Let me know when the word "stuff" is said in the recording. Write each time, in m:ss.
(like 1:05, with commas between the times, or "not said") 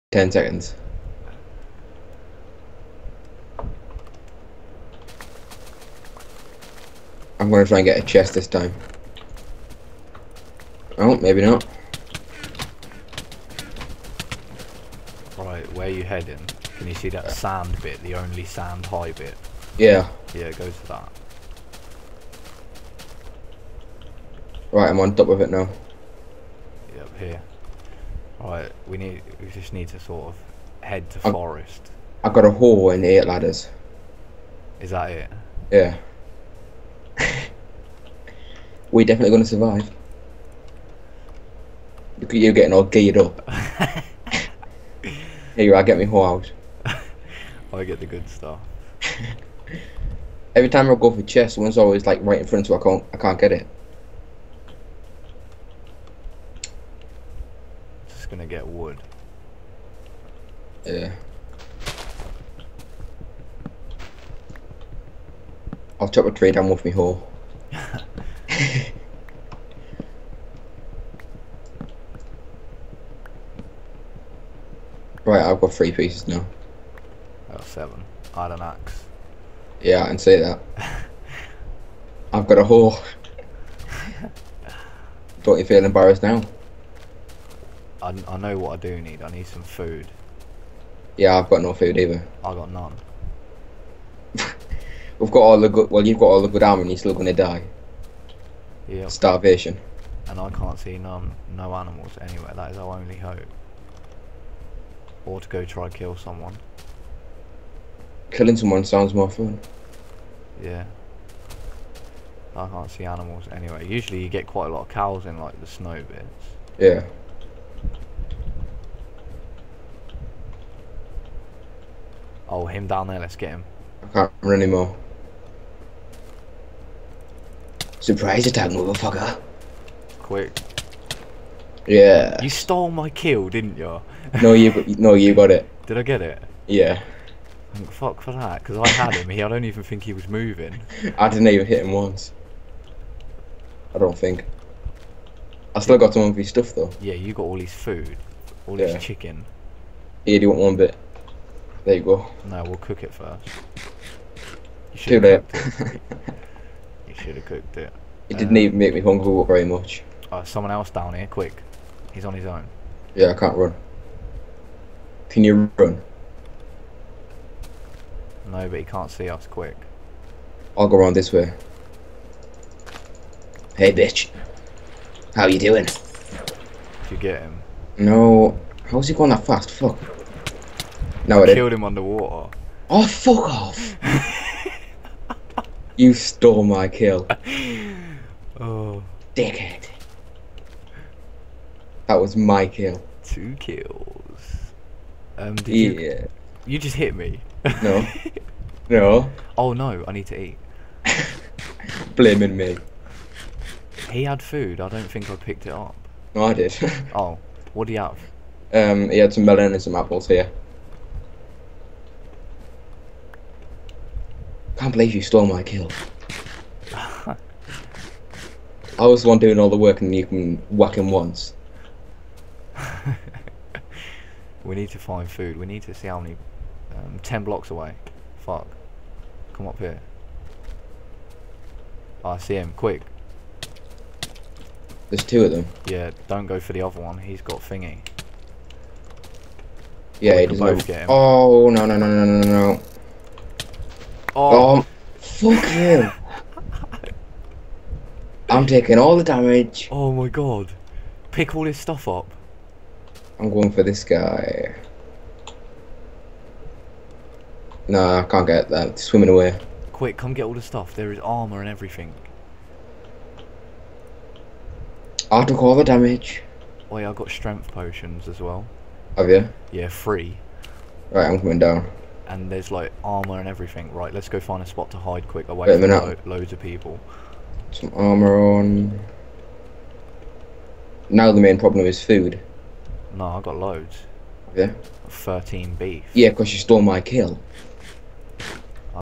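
0:48, 2:26, 4:11, 4:20.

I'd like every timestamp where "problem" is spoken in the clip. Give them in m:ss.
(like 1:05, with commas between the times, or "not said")
4:41.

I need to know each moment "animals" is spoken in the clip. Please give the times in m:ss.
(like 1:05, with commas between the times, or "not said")
1:41, 1:53.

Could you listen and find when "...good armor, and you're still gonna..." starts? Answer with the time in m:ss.
1:36.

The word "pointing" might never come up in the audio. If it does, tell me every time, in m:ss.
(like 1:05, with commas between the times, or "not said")
not said.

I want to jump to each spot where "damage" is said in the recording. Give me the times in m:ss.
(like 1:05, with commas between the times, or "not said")
4:09, 4:25.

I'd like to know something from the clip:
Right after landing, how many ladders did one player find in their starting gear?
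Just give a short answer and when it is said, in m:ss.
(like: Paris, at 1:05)
8, at 0:33.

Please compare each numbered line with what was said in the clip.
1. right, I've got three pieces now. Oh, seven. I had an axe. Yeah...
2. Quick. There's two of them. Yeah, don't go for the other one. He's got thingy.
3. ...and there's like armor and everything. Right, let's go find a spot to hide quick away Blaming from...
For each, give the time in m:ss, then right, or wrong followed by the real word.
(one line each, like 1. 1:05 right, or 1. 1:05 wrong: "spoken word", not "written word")
1. 1:15 right
2. 3:52 right
3. 4:32 wrong: "Wait", not "Blaming".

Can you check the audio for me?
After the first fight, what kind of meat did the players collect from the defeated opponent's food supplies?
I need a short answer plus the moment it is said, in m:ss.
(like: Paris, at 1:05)
Chicken, at 2:29.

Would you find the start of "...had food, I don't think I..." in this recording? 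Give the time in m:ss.
3:24.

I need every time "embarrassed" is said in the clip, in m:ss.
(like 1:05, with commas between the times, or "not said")
1:25.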